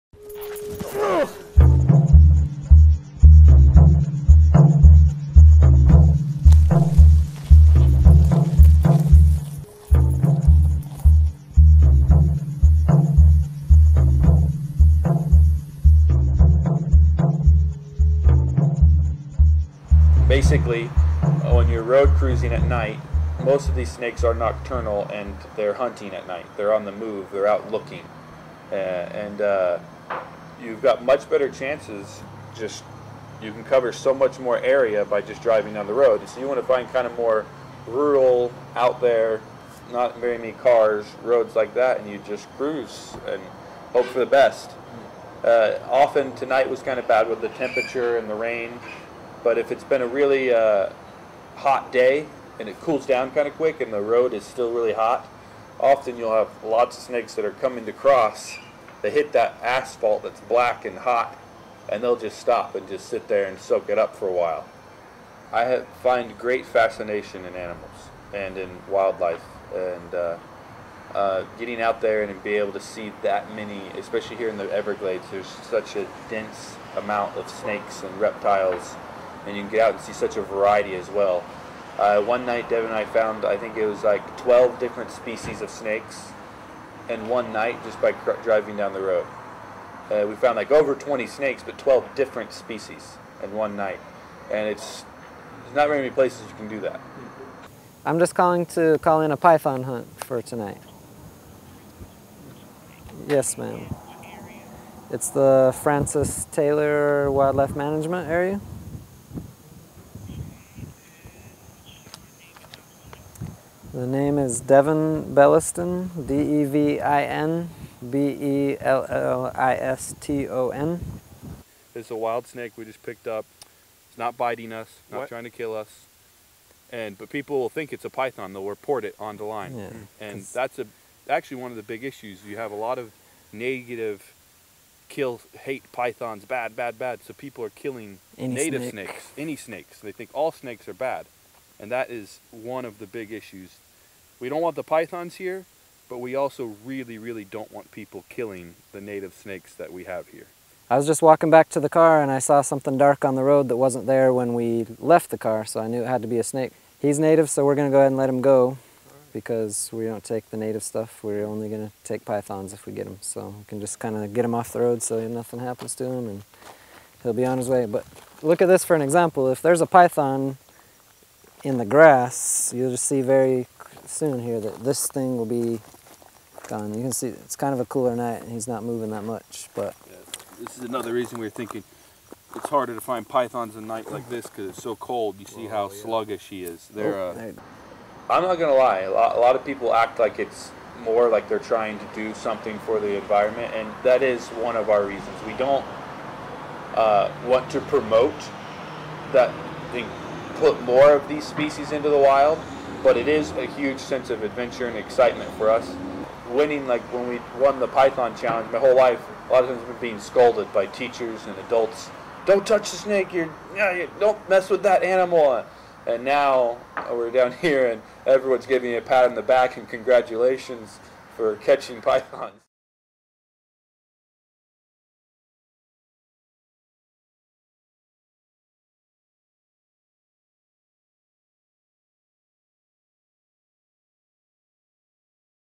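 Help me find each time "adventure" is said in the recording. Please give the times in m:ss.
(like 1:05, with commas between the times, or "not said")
3:24.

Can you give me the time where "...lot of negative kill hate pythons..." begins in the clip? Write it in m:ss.
2:12.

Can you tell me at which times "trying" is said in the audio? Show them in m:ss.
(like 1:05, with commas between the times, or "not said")
2:05, 3:11.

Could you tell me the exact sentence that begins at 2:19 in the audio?
snakes any snakes they think all snakes are bad and that is one of the big issues.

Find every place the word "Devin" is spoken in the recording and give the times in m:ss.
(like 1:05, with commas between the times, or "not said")
1:22, 1:54.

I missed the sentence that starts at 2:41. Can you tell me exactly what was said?
We're only going to take pythons if we get them.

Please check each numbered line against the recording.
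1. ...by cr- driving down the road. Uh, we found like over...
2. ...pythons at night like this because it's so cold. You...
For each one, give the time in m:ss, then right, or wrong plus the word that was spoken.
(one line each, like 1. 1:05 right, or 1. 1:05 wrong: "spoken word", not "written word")
1. 1:28 right
2. 3:03 right.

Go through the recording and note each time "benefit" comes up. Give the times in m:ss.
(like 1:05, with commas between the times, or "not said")
not said.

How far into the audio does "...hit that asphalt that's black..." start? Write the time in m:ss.
0:59.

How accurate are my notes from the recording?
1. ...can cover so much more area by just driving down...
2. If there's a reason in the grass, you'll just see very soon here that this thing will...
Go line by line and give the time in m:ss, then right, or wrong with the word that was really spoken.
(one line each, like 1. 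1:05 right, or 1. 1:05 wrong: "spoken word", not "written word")
1. 0:33 right
2. 2:49 wrong: "python", not "reason".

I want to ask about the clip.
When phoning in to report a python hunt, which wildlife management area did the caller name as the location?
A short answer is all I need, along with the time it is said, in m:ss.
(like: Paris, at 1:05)
Francis Taylor Wildlife Management Area, at 1:45.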